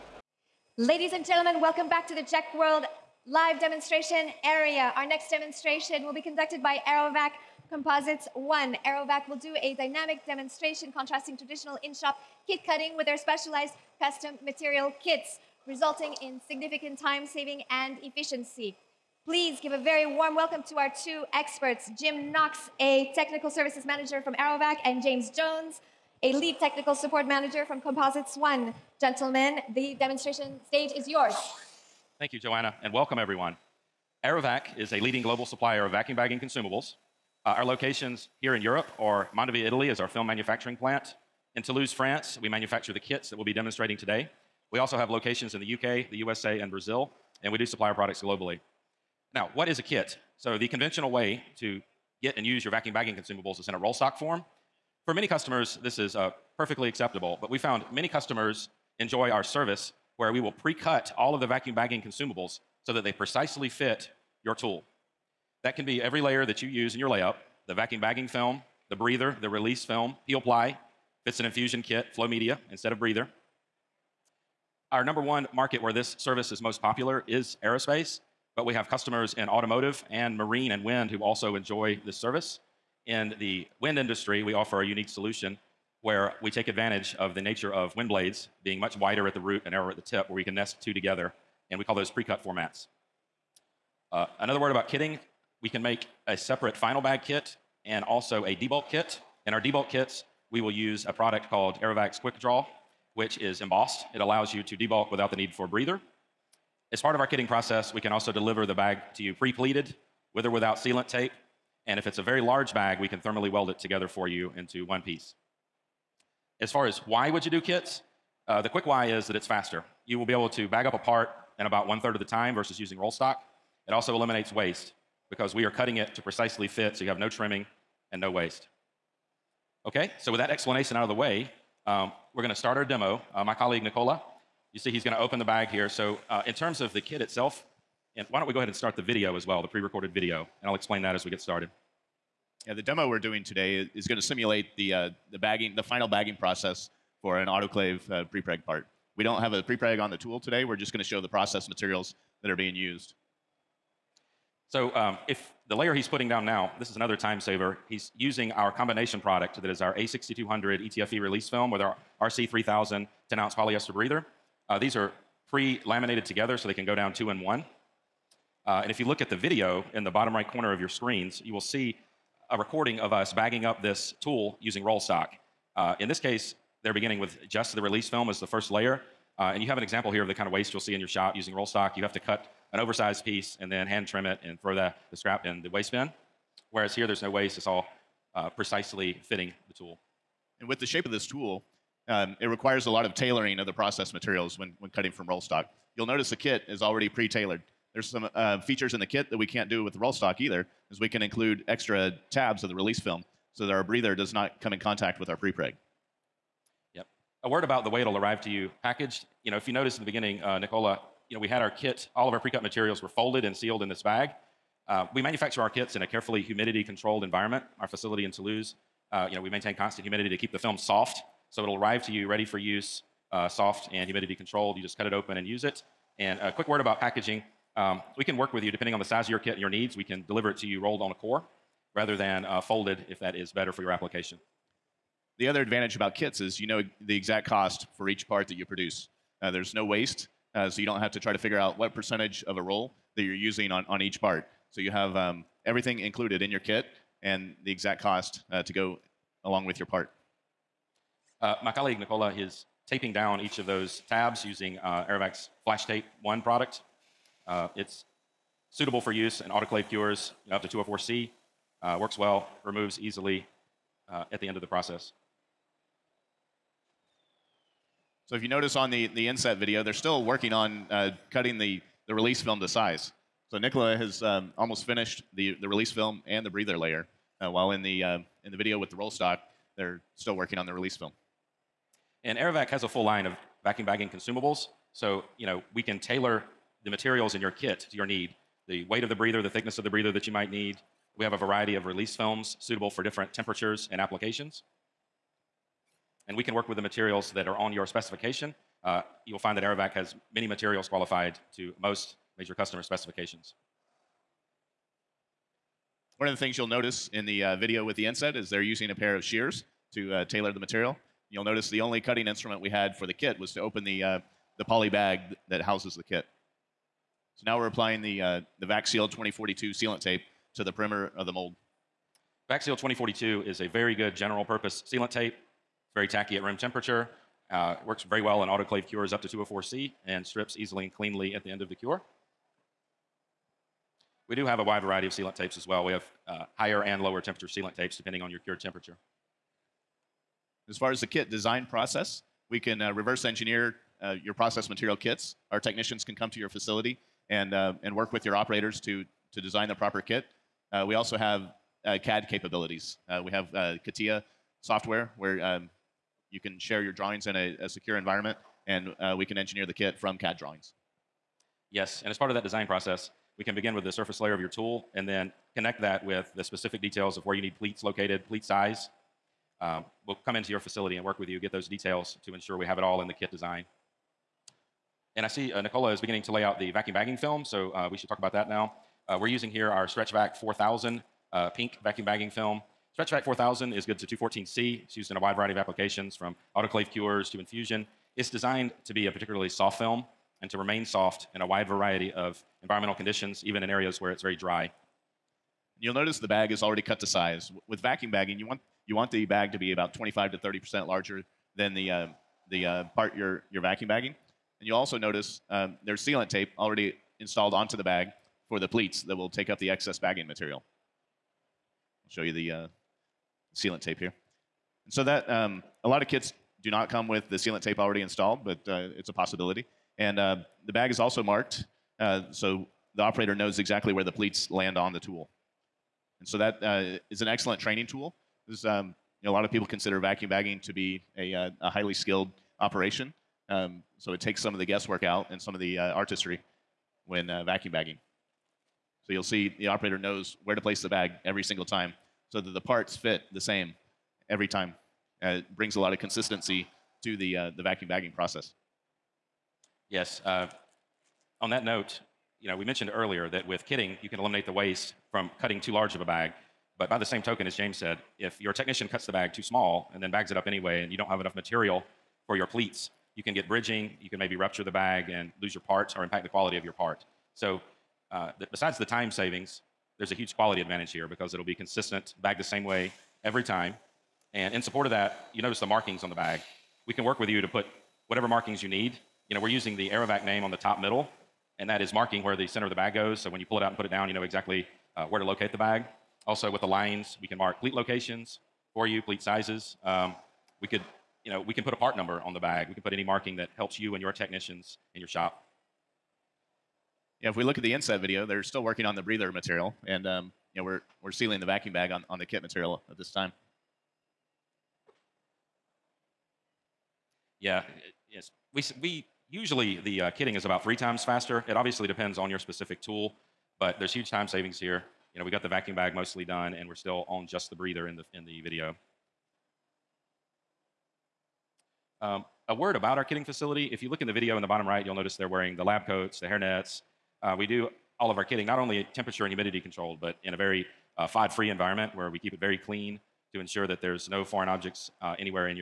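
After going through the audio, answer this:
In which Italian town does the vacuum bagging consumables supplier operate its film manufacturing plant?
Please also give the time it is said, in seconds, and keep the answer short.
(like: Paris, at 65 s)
Mondovì, at 39 s.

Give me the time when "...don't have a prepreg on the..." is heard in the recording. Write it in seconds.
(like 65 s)
149 s.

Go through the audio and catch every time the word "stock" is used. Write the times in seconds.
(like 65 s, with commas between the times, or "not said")
53 s, 123 s, 175 s, 181 s, 195 s, 200 s, 279 s.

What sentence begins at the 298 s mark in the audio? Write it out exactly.
Uh, you'll find that Aerovac has many materials qualified to most major customer specifications.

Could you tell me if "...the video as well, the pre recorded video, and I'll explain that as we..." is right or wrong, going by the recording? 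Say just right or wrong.
right.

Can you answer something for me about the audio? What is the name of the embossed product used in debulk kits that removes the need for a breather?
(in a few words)
Quick Draw.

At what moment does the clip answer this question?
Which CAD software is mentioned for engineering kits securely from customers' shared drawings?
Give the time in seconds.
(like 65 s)
353 s.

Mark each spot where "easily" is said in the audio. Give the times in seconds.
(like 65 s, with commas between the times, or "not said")
262 s, 330 s.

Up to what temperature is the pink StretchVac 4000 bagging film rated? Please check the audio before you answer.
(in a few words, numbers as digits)
214C.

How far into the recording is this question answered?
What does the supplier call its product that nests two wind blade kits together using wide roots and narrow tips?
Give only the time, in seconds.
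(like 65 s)
92 s.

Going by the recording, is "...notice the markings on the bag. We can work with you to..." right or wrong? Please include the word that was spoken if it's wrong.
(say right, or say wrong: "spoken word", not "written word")
right.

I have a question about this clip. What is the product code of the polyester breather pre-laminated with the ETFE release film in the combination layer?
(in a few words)
RC3000.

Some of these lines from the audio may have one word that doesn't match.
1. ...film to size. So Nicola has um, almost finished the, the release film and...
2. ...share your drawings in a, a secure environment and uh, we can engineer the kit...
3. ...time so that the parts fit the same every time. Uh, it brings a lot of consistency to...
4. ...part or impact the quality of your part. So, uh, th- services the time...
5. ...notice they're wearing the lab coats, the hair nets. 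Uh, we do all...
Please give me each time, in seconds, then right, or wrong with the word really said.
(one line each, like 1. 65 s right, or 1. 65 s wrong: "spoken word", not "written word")
1. 272 s right
2. 356 s right
3. 441 s right
4. 465 s wrong: "besides", not "services"
5. 524 s right.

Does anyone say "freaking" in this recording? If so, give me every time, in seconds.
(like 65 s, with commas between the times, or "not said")
not said.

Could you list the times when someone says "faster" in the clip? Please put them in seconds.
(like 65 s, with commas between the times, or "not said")
119 s, 511 s.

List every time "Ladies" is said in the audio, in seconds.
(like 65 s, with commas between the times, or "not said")
0 s.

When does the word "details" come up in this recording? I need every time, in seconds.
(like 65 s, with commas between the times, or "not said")
366 s, 371 s.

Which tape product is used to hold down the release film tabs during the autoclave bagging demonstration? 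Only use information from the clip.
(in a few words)
Flash Tape 1.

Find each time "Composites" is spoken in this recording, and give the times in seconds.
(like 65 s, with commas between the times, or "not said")
7 s, 27 s.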